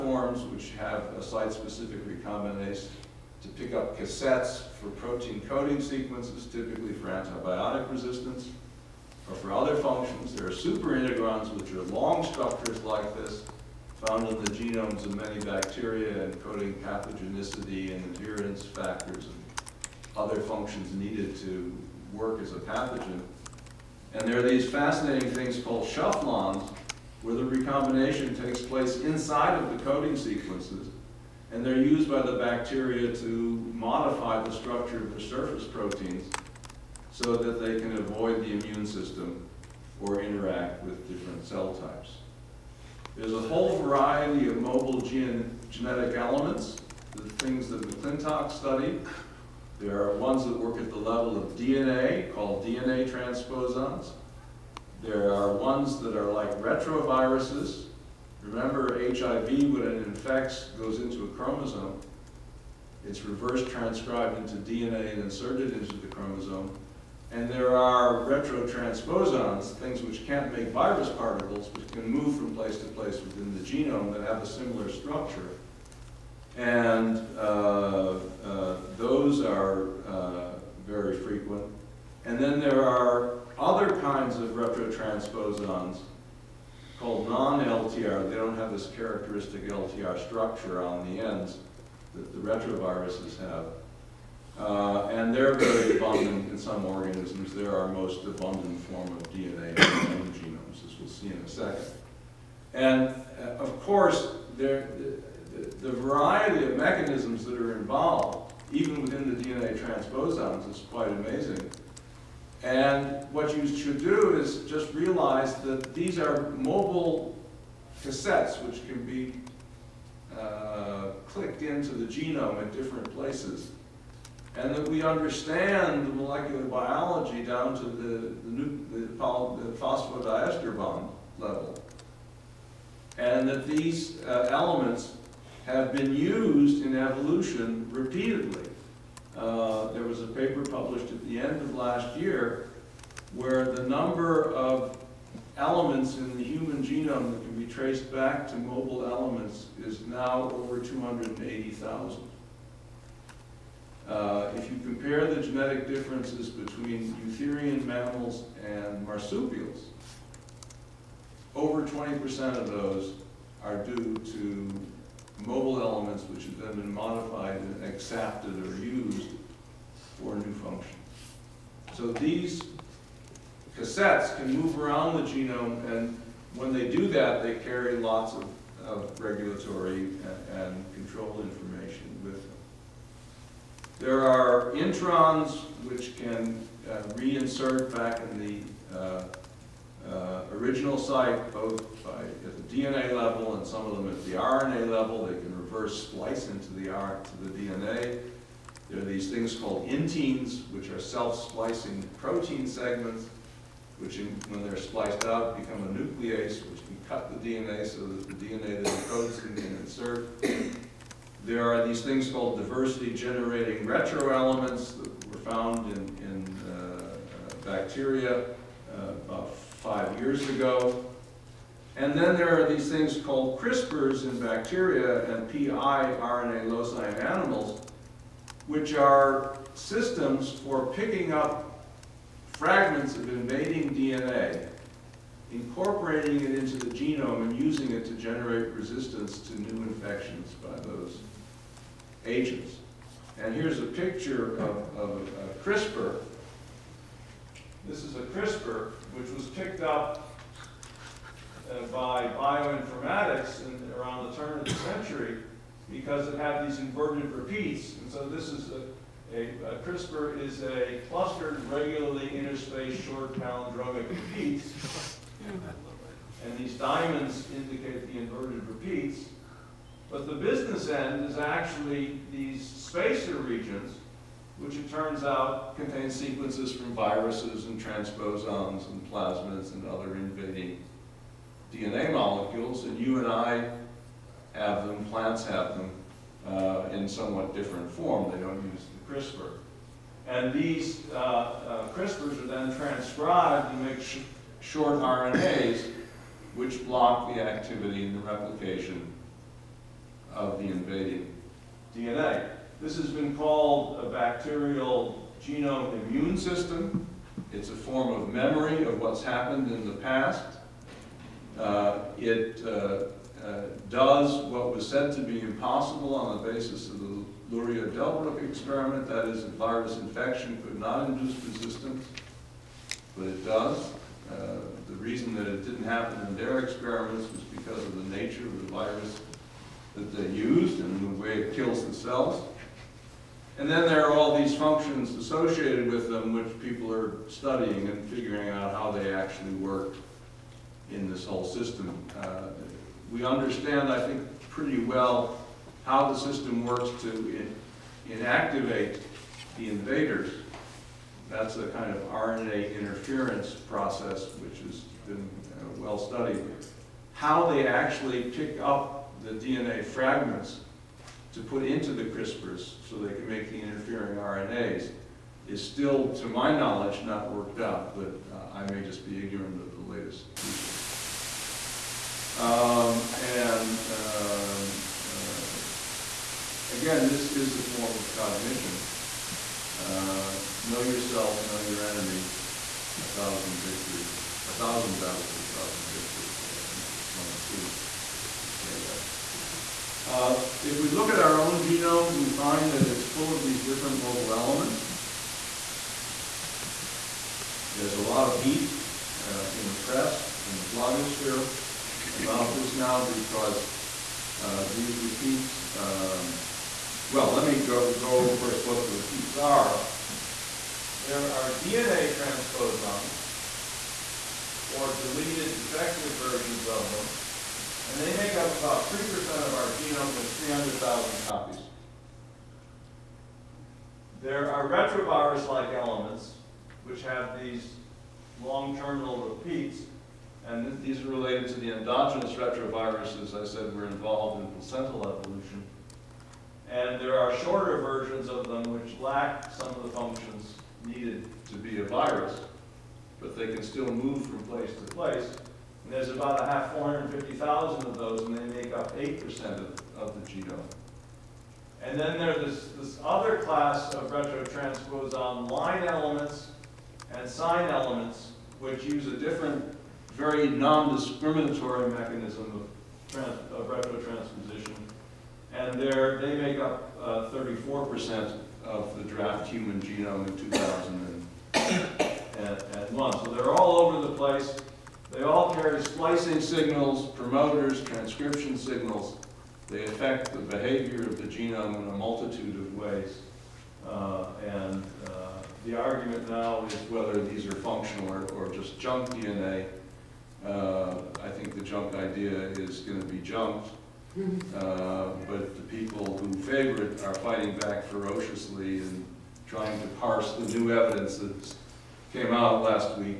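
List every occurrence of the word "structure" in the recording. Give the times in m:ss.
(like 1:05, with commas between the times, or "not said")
0:12, 0:34, 1:14, 1:30.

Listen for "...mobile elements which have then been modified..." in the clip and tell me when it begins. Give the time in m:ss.
2:45.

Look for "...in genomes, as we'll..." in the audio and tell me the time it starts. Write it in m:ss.
1:39.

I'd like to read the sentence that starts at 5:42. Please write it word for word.
Uh, we understand, I think, pretty well how the system works to in inactivate the invaders.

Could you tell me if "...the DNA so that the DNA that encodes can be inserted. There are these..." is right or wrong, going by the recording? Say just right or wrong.
right.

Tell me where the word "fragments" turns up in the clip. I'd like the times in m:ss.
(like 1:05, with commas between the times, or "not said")
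3:52, 5:59.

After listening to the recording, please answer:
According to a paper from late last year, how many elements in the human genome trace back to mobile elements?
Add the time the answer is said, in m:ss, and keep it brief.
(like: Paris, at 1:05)
over 280,000, at 2:30.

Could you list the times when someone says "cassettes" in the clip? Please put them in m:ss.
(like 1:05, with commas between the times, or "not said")
0:03, 1:58, 2:53.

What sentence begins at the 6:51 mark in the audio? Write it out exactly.
There are DNA transposons, or deleted defective versions of them, and they make up about 3% of our genome, there's 300,000 copies.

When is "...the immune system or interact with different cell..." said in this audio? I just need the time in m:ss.
0:38.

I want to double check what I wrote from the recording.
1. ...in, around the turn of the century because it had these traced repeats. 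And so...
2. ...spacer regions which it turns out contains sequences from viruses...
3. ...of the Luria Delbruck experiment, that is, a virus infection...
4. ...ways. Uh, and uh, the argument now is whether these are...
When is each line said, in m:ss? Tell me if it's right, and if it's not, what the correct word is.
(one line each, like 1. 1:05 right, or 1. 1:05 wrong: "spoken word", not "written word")
1. 4:13 wrong: "inverted", not "traced"
2. 4:32 right
3. 5:16 right
4. 8:02 right.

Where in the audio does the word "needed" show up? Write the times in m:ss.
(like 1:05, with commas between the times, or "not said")
0:20, 7:20.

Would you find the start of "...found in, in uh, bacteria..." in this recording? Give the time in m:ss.
3:35.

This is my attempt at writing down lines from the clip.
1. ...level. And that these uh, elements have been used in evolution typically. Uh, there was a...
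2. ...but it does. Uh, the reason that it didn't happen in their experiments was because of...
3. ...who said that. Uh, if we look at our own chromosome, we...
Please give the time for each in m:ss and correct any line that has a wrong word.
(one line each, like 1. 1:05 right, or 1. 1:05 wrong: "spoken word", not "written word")
1. 2:11 wrong: "repeatedly", not "typically"
2. 5:23 right
3. 6:27 wrong: "genome", not "chromosome".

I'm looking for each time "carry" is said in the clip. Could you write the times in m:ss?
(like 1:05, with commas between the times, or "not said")
2:57, 7:55.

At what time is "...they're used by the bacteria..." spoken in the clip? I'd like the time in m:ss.
0:31.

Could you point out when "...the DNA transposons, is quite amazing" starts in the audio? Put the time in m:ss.
1:49.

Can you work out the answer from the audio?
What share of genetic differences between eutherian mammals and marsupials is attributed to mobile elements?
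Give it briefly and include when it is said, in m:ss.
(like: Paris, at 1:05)
over 20%, at 2:41.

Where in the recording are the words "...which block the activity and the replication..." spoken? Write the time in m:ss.
4:56.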